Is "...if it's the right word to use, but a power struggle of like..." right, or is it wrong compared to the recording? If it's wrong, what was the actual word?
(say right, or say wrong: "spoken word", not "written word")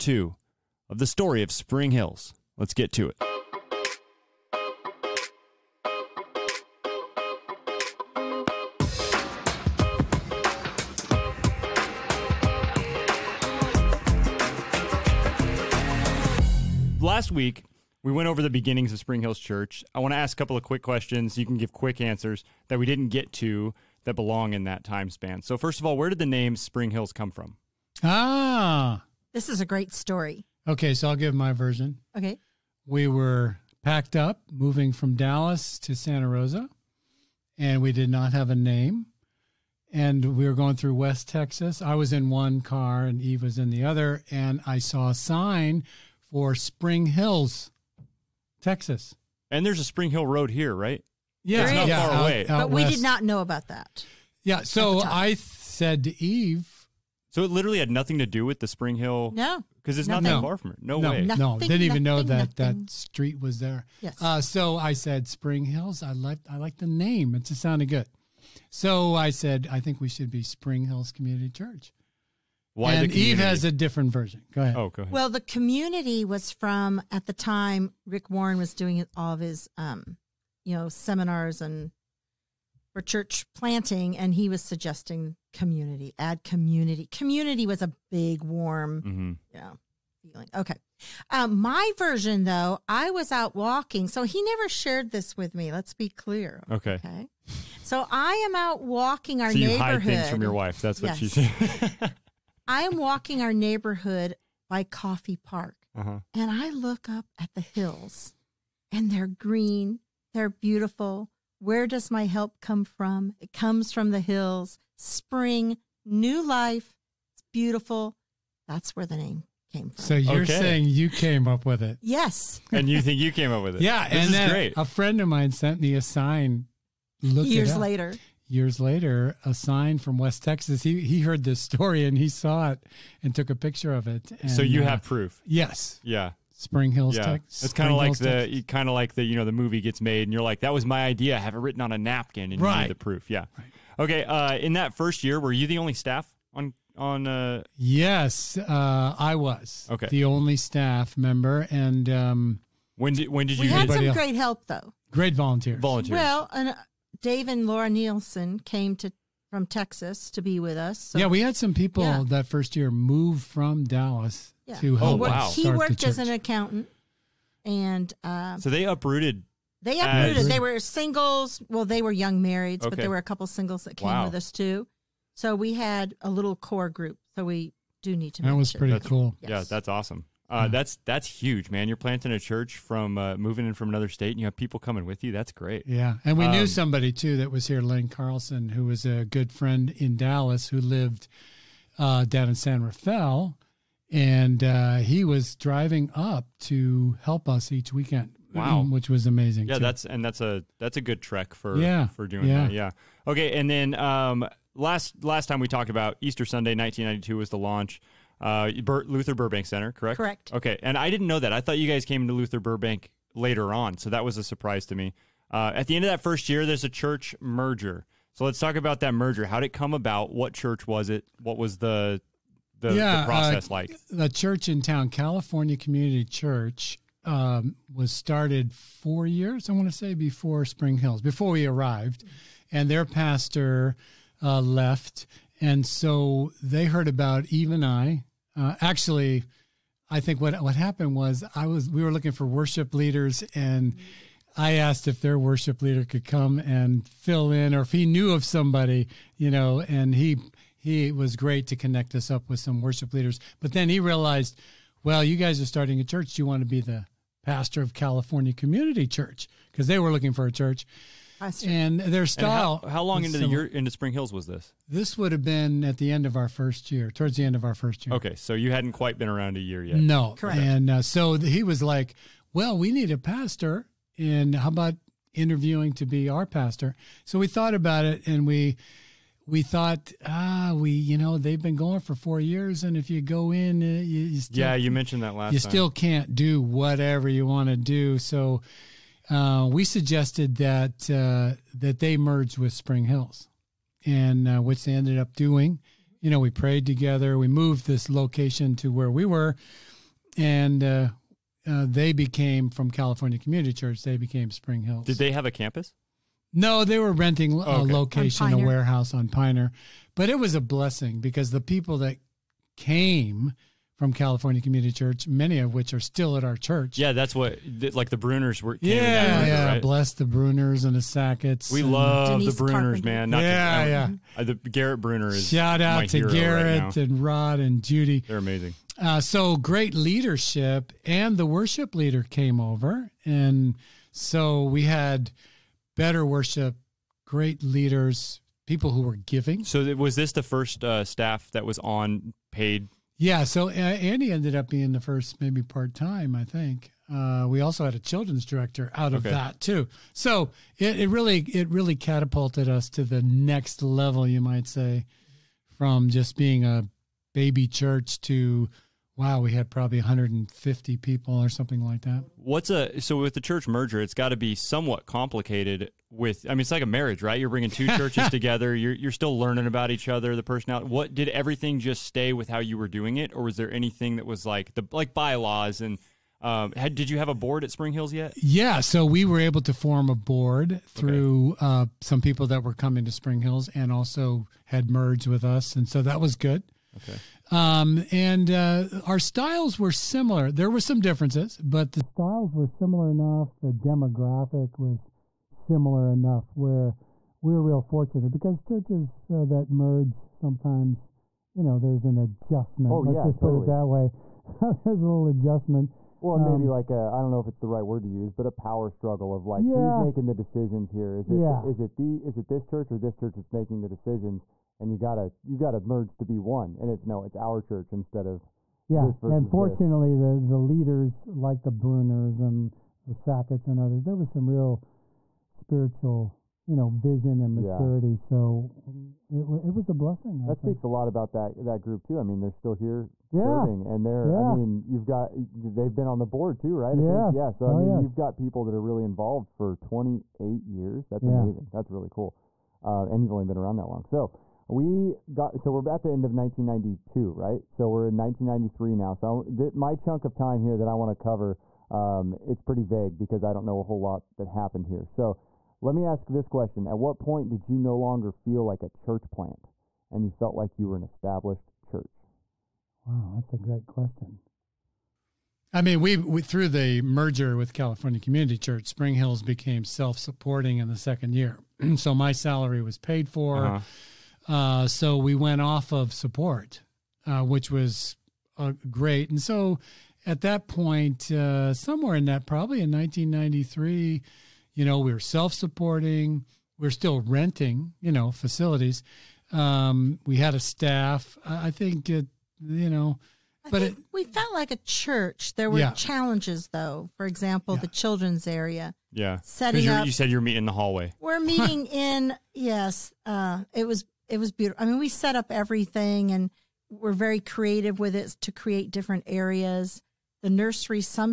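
right.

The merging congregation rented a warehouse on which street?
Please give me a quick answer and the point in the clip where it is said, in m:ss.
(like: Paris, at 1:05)
Piner, at 5:09.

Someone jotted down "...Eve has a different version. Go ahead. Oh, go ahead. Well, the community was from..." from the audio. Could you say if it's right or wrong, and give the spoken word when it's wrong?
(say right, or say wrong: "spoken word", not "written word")
right.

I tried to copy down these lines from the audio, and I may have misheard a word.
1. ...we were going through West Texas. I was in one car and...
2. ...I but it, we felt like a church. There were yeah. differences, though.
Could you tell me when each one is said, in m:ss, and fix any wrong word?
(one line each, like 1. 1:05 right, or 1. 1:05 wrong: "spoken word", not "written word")
1. 0:40 right
2. 8:13 wrong: "challenges", not "differences".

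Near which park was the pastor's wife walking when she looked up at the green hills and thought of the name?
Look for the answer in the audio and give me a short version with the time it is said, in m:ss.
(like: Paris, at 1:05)
Coffey Park, at 1:44.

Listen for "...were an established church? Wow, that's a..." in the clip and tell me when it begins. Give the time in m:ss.
7:40.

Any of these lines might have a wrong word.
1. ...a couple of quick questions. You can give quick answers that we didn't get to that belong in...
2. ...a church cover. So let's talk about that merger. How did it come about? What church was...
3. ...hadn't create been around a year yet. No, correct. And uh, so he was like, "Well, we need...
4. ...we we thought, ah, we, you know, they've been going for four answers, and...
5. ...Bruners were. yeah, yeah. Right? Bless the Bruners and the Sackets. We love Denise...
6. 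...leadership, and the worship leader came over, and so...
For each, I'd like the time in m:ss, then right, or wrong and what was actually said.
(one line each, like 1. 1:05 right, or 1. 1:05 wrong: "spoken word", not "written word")
1. 0:20 right
2. 3:36 wrong: "merger", not "cover"
3. 4:28 wrong: "quite", not "create"
4. 4:38 wrong: "years", not "answers"
5. 5:18 right
6. 5:29 right.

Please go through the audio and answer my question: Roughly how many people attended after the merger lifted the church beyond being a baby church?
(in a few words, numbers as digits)
150.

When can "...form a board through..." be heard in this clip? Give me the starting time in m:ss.
6:19.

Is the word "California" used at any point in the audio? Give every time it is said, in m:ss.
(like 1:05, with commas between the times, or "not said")
3:45, 4:17, 5:02, 5:14, 7:47.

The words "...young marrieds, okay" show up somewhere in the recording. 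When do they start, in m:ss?
2:52.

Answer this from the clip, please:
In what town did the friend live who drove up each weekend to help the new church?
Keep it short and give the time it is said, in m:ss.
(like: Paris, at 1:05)
San Rafael, at 3:12.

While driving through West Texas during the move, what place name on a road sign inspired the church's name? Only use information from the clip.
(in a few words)
Spring Hills, Texas.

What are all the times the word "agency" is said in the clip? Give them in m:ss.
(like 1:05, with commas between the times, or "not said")
not said.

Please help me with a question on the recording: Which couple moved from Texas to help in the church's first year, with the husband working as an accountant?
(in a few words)
Dave and Laura Nielsen.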